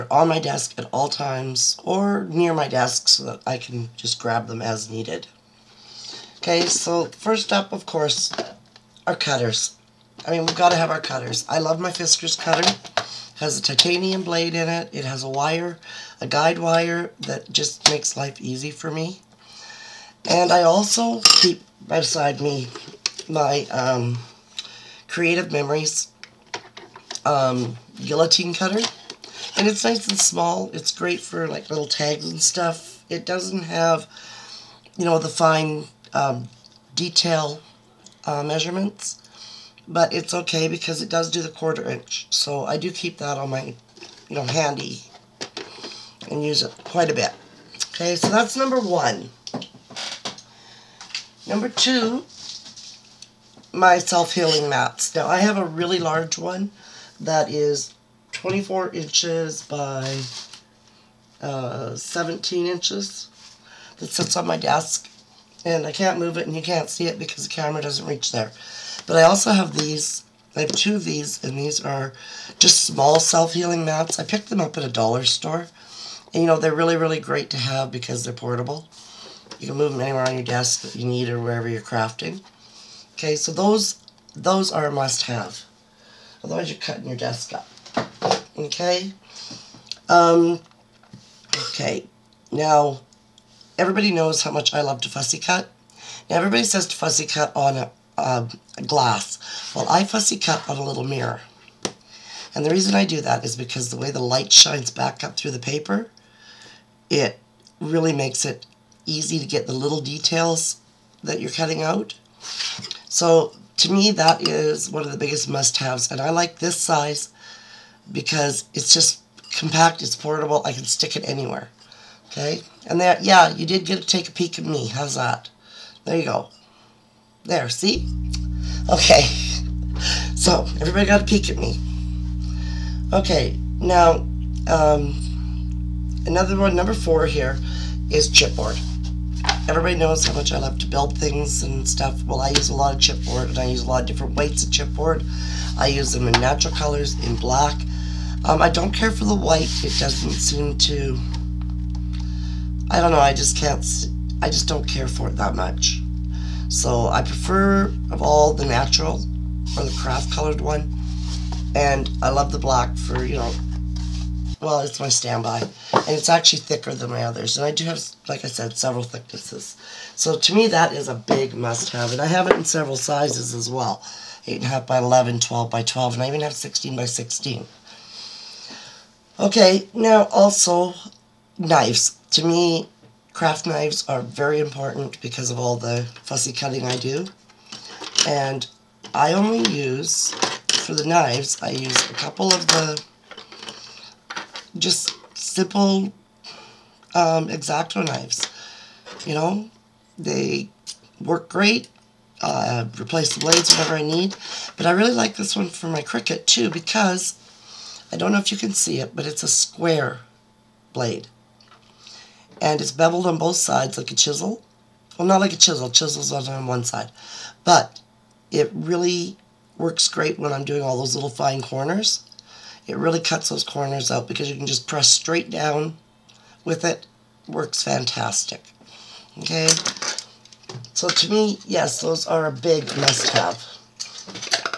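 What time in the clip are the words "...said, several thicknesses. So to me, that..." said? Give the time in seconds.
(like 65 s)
168 s.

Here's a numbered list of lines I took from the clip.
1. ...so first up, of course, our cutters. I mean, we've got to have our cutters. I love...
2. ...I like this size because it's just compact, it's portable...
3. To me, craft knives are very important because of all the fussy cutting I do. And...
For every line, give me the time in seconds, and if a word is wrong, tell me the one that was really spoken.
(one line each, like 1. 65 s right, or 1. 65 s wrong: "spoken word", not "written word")
1. 6 s right
2. 116 s right
3. 182 s right.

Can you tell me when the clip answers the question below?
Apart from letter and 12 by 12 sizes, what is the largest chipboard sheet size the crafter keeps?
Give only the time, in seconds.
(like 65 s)
176 s.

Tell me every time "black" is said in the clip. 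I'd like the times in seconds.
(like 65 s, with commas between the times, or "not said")
147 s, 162 s.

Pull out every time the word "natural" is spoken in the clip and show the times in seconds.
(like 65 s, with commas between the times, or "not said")
146 s, 158 s.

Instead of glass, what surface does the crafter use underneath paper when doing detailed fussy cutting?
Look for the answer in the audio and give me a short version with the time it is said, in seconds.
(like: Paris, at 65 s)
a little mirror, at 100 s.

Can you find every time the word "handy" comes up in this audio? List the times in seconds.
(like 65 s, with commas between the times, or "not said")
44 s.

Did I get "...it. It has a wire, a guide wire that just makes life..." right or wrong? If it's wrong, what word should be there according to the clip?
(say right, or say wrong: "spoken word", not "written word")
right.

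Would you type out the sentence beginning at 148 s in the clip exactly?
Um, I don't care for the white.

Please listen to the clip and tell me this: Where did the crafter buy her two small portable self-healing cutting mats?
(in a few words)
a dollar store.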